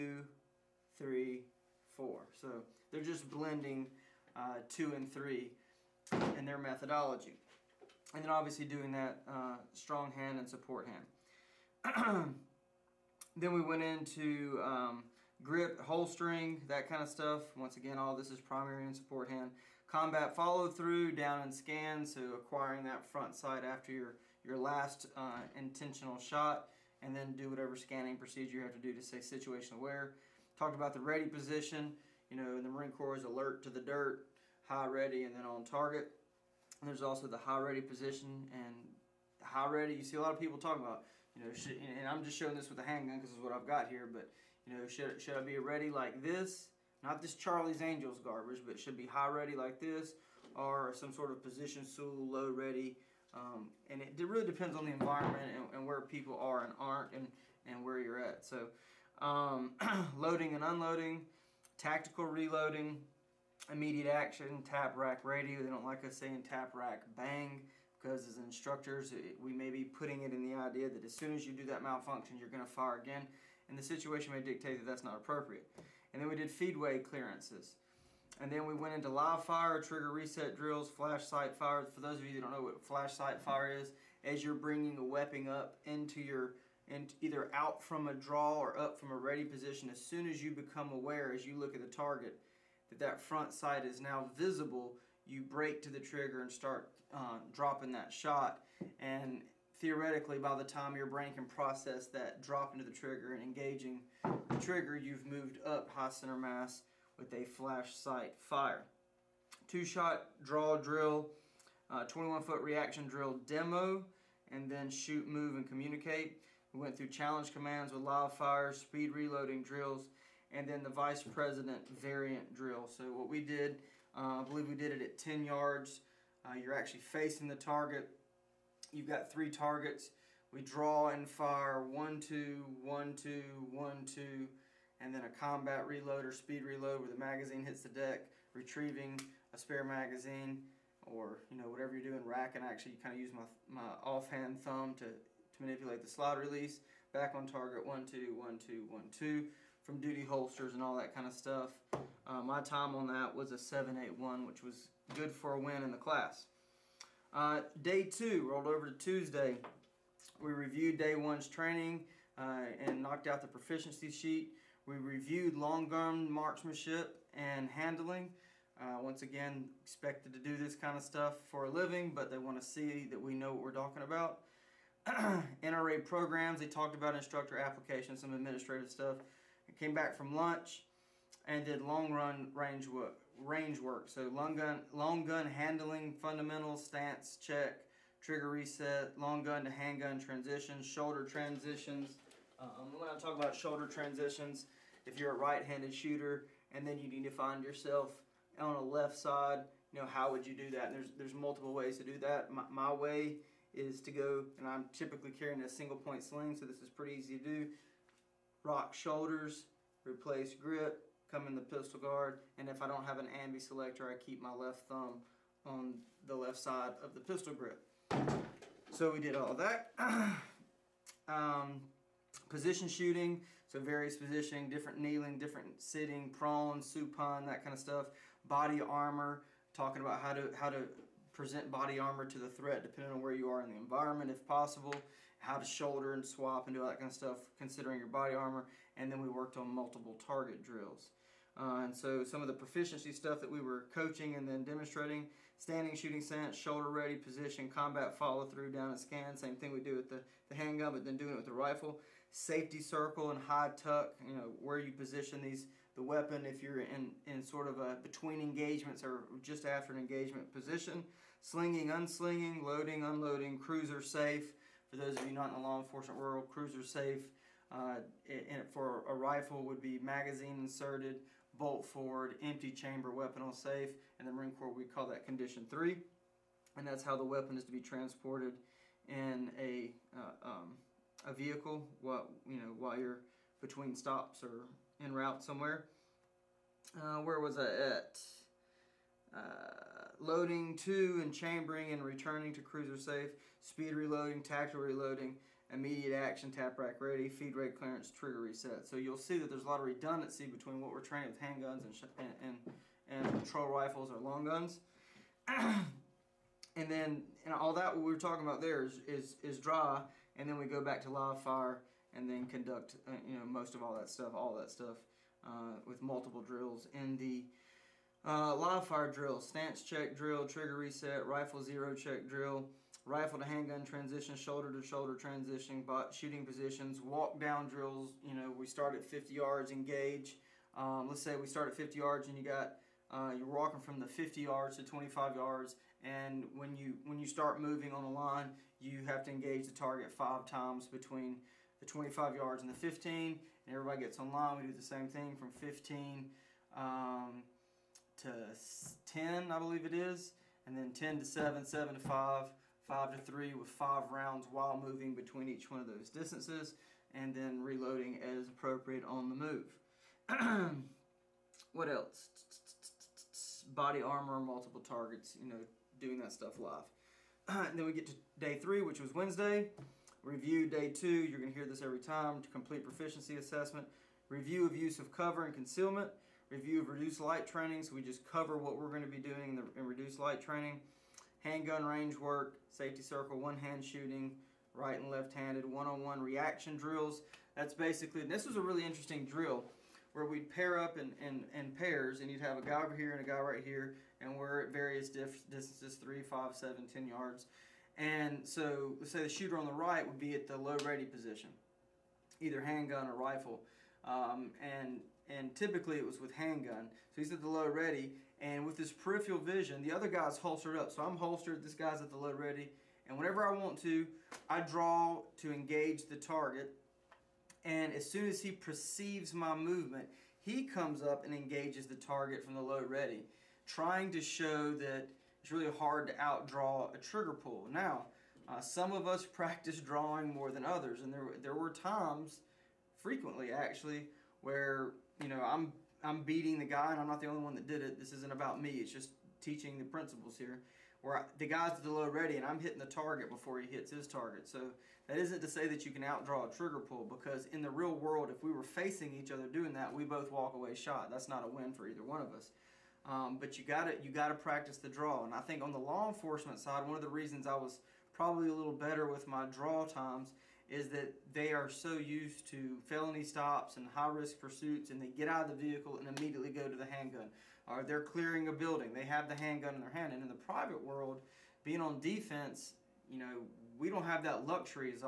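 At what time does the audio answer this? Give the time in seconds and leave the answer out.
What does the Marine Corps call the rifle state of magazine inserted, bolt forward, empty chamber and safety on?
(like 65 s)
275 s.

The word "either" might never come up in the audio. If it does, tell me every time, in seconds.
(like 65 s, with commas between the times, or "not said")
87 s, 402 s, 451 s.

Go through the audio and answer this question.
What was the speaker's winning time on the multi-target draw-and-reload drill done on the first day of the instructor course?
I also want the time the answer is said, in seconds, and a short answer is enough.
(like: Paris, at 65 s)
7.81, at 153 s.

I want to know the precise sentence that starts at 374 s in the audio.
Review of use of cover and concealment.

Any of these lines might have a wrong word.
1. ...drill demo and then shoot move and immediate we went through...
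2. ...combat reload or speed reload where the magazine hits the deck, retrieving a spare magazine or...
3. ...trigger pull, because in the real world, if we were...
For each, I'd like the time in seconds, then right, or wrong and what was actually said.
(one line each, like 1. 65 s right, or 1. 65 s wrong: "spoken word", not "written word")
1. 113 s wrong: "communicate", not "immediate"
2. 135 s right
3. 446 s right.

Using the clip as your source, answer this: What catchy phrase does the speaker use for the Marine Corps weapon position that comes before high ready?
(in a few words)
alert to the dirt.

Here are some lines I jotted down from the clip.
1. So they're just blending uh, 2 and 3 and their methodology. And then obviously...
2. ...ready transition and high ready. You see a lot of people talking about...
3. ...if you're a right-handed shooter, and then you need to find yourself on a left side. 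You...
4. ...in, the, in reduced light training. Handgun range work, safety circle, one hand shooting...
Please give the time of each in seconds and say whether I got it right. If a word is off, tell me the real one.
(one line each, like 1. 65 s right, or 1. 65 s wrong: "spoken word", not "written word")
1. 2 s right
2. 37 s wrong: "position", not "transition"
3. 195 s right
4. 379 s right.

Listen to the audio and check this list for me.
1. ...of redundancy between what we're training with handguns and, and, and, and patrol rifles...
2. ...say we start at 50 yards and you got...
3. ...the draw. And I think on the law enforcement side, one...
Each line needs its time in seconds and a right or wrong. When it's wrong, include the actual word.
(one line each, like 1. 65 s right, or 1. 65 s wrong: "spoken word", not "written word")
1. 299 s right
2. 331 s right
3. 454 s right.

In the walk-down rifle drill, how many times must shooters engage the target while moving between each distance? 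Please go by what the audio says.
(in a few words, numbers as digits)
5.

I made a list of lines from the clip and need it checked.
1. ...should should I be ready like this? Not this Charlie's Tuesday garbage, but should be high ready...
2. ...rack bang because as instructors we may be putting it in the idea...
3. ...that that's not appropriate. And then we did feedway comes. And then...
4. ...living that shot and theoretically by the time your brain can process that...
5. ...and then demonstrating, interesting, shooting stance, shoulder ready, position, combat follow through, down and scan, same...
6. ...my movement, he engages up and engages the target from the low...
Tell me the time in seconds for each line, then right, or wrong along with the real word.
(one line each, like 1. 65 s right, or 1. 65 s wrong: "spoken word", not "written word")
1. 44 s wrong: "Angels", not "Tuesday"
2. 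66 s right
3. 74 s wrong: "clearances", not "comes"
4. 97 s wrong: "dropping", not "living"
5. 244 s wrong: "standing", not "interesting"
6. 419 s wrong: "comes", not "engages".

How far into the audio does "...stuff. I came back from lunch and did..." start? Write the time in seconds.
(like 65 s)
178 s.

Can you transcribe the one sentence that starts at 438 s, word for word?
It's just teaching the principles here.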